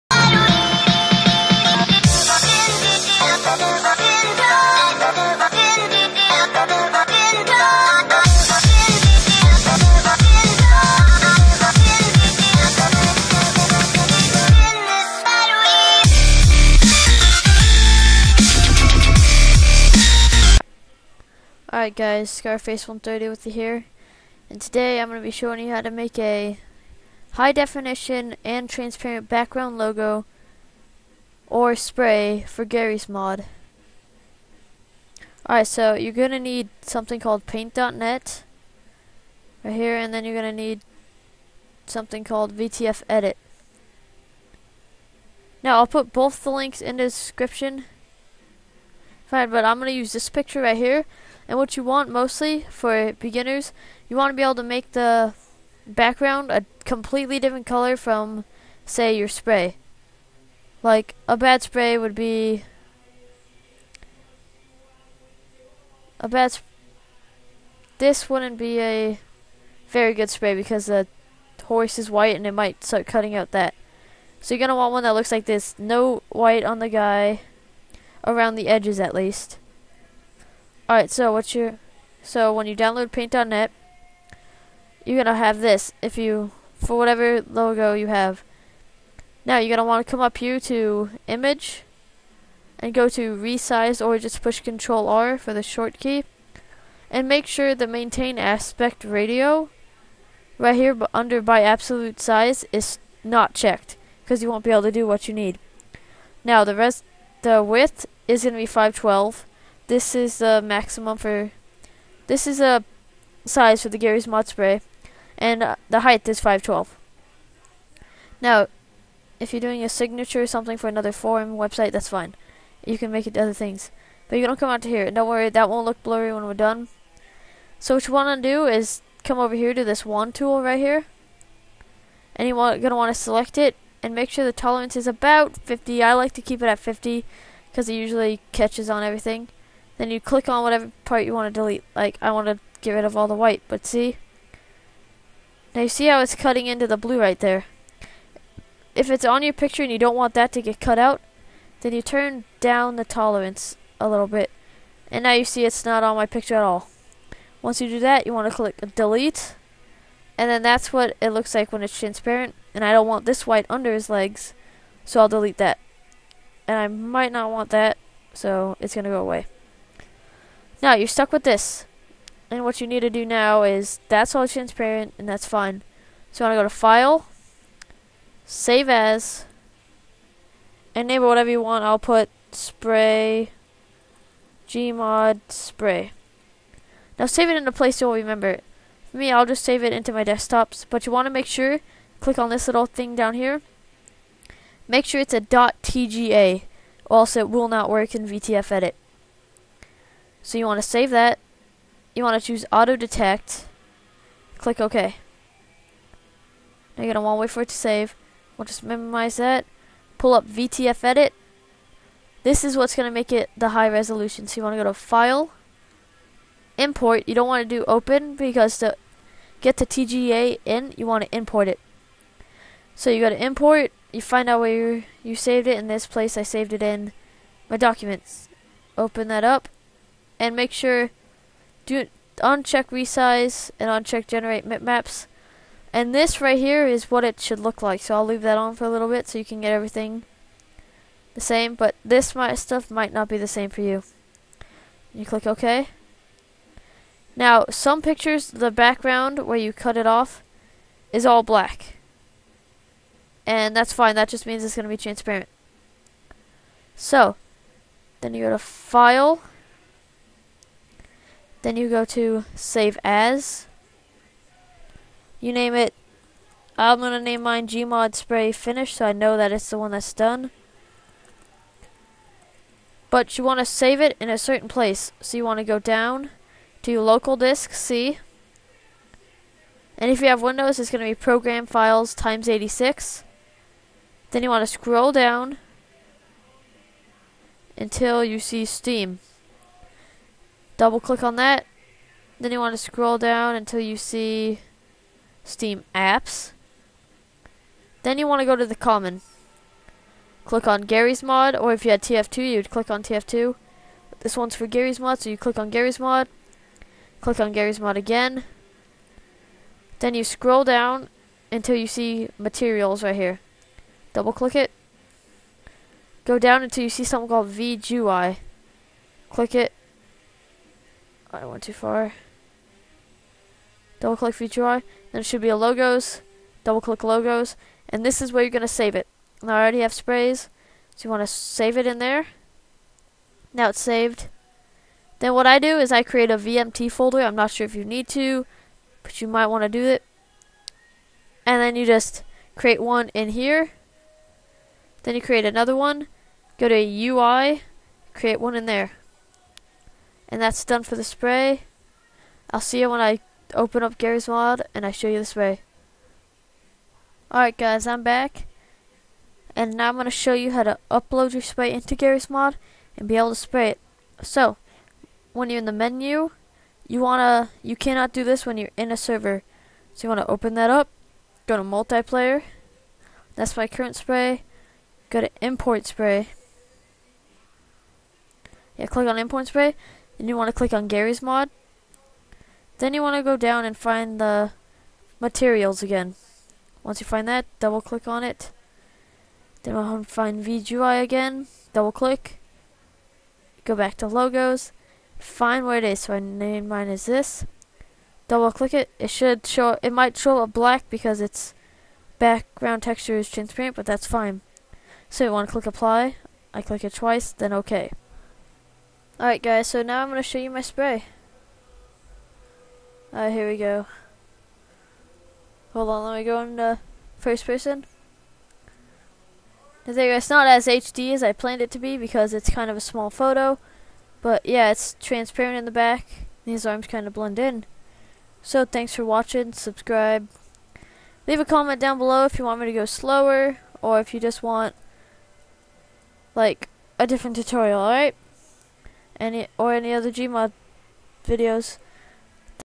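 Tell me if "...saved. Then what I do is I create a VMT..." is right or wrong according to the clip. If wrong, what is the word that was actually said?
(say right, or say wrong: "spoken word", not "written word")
right.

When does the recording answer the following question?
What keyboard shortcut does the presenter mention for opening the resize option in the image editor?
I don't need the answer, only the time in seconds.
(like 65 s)
94 s.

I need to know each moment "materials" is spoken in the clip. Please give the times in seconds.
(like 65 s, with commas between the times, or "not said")
312 s, 385 s.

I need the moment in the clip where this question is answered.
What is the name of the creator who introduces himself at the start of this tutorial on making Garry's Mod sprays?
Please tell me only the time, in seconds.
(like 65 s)
22 s.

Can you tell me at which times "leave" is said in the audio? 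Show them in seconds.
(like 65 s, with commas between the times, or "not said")
238 s, 431 s.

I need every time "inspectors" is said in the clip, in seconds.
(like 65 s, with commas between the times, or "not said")
not said.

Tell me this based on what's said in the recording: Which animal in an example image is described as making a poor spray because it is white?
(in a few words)
Horse.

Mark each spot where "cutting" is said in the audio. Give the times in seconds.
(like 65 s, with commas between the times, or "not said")
73 s, 146 s.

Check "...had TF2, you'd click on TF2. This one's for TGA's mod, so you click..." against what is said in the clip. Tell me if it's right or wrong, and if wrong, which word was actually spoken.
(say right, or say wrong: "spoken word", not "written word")
wrong: "Garry", not "TGA".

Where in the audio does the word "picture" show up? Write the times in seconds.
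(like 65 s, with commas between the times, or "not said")
50 s, 149 s, 156 s, 248 s.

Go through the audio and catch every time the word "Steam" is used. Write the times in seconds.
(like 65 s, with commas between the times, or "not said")
288 s, 295 s.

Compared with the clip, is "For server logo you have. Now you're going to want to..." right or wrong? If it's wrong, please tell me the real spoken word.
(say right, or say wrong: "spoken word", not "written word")
wrong: "whatever", not "server".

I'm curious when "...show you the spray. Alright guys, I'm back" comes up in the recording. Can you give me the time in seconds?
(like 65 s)
354 s.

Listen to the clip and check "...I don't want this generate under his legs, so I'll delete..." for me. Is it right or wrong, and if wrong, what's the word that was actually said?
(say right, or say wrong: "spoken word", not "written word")
wrong: "white", not "generate".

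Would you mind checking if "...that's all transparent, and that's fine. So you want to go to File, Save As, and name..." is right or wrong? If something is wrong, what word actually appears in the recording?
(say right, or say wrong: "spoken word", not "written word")
right.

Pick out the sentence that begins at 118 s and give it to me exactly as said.
Now, if you're doing a signature or something for another forum website, that's fine.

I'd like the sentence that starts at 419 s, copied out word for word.
There it's not as HD as I planned it to be because it's kind of a small photo.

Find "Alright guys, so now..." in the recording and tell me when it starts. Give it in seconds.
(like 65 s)
409 s.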